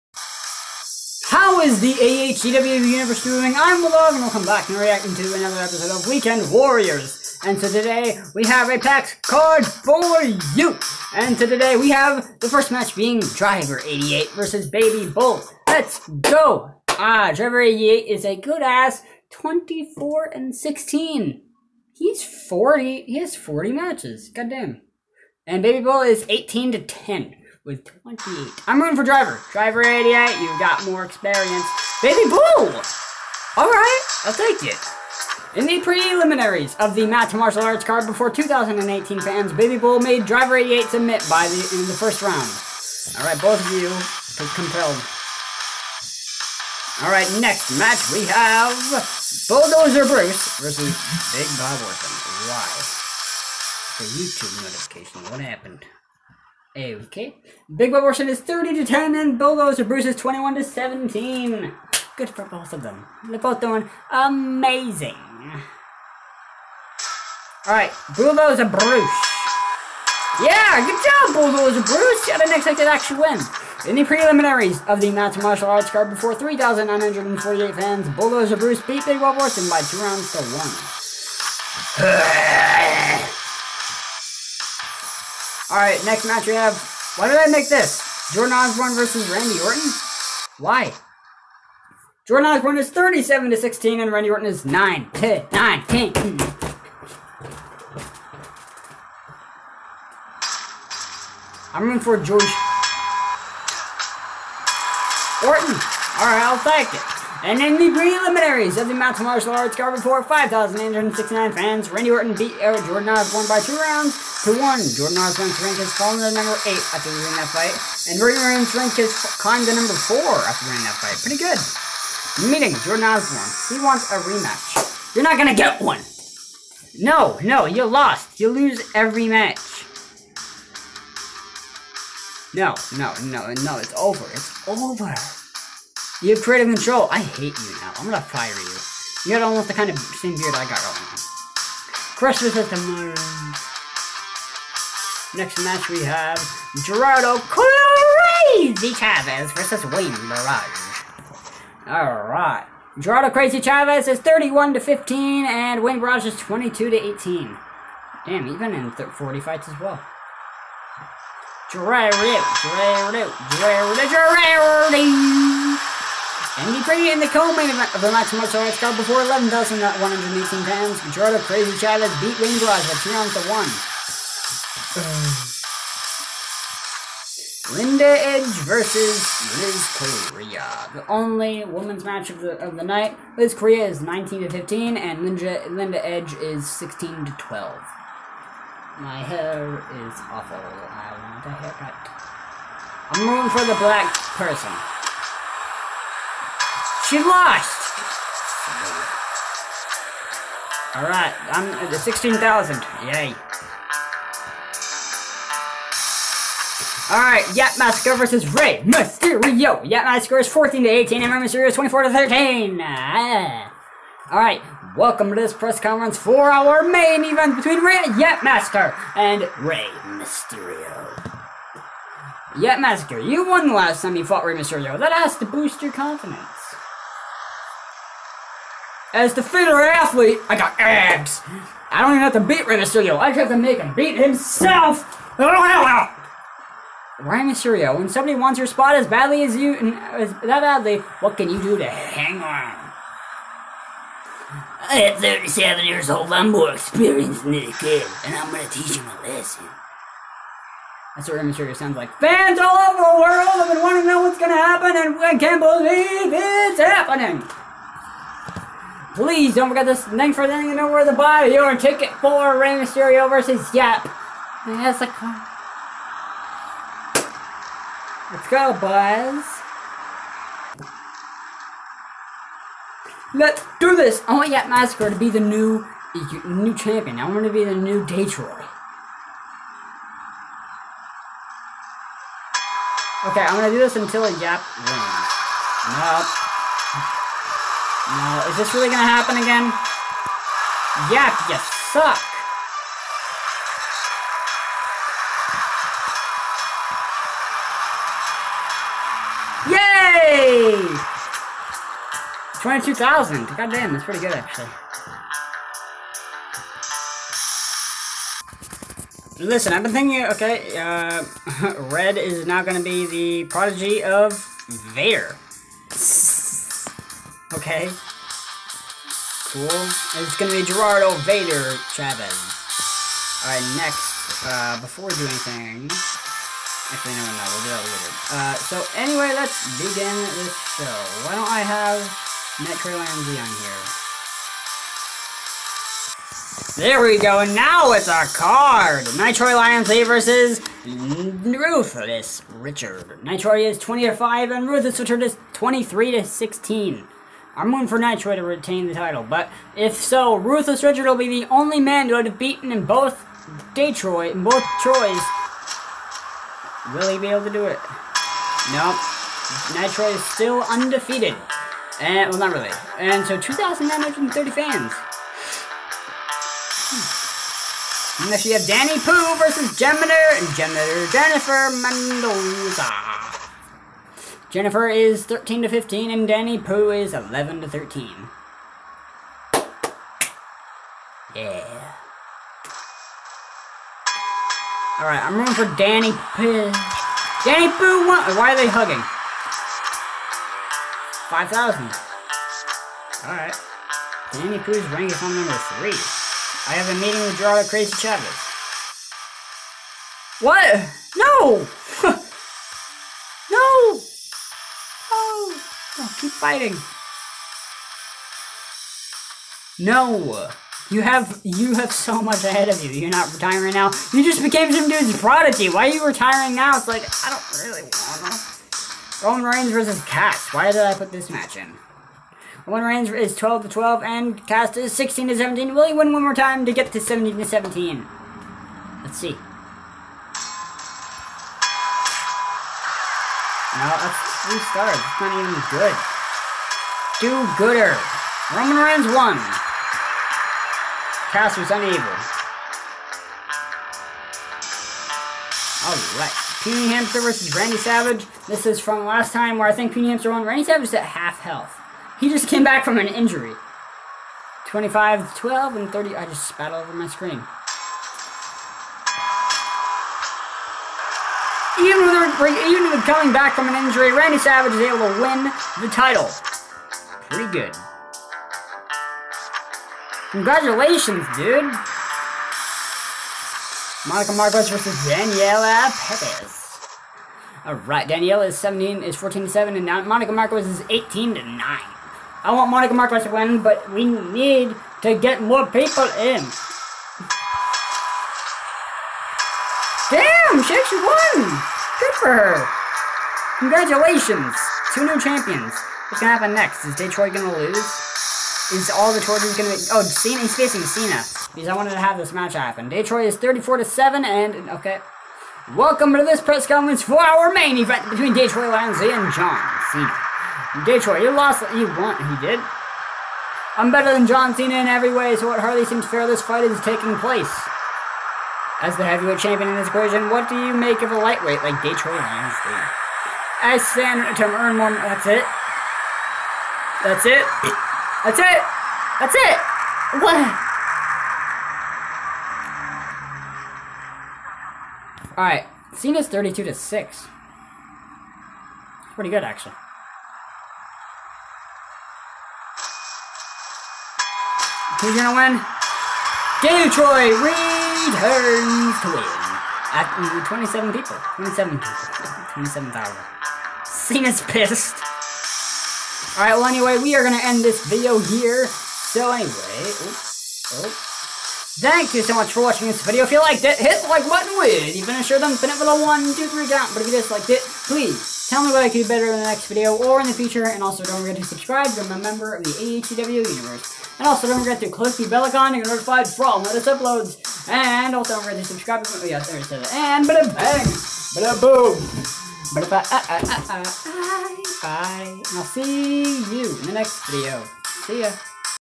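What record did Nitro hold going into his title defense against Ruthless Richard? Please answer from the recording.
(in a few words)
20 to 5.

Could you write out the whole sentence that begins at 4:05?
At 37 years old, I'm more experienced than this kid, and I'm gonna teach him a lesson.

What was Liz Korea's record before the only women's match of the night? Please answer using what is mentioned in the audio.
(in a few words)
19 to 15.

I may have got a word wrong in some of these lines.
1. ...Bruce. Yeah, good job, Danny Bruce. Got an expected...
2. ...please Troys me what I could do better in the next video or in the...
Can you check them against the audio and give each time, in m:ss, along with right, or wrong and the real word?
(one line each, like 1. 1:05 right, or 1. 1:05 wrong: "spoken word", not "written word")
1. 1:08 wrong: "Bulldozer", not "Danny"
2. 9:27 wrong: "Tell", not "Troys".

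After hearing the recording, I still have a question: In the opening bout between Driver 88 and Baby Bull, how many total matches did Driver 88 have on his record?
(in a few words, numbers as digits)
40.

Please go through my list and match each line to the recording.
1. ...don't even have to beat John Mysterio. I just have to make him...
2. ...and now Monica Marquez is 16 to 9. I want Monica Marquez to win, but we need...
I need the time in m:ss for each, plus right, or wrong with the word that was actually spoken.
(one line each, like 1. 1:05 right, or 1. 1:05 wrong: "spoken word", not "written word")
1. 3:52 wrong: "Rey", not "John"
2. 7:59 wrong: "18", not "16".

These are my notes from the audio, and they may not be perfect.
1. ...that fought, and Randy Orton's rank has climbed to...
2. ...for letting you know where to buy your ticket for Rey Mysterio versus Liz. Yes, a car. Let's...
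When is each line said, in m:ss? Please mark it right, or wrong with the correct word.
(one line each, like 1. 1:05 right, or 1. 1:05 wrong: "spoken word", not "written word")
1. 1:57 wrong: "fight", not "fought"
2. 4:20 wrong: "Yap", not "Liz".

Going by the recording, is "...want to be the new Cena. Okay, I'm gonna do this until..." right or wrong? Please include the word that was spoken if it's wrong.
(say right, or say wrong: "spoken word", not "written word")
wrong: "Detroit", not "Cena".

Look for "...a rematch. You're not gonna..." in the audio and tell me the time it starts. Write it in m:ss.
2:04.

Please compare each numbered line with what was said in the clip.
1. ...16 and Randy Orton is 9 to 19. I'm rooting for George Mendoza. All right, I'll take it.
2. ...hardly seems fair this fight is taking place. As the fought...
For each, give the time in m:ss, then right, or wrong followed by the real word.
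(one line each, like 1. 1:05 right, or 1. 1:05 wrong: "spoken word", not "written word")
1. 1:33 wrong: "Orton", not "Mendoza"
2. 8:35 wrong: "heavyweight", not "fought".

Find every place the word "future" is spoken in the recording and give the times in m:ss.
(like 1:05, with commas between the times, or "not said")
9:30.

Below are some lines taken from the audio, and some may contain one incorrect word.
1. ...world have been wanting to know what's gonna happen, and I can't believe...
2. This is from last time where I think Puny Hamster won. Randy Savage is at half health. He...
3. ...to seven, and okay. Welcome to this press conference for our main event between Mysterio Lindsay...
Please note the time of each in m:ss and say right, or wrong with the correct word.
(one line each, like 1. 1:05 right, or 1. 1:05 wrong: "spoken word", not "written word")
1. 4:13 right
2. 7:28 right
3. 8:23 wrong: "Detroit", not "Mysterio".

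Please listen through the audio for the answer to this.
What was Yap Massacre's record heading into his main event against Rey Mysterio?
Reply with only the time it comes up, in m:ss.
3:30.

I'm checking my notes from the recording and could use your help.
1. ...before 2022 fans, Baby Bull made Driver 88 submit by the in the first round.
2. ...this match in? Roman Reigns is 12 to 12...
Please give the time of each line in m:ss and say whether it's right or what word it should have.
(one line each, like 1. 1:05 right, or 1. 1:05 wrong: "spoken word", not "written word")
1. 0:38 wrong: "2018", not "2022"
2. 7:01 right.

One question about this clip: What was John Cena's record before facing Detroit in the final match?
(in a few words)
32 to 6.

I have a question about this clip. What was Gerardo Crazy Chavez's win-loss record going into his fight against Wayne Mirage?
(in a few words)
31 to 15.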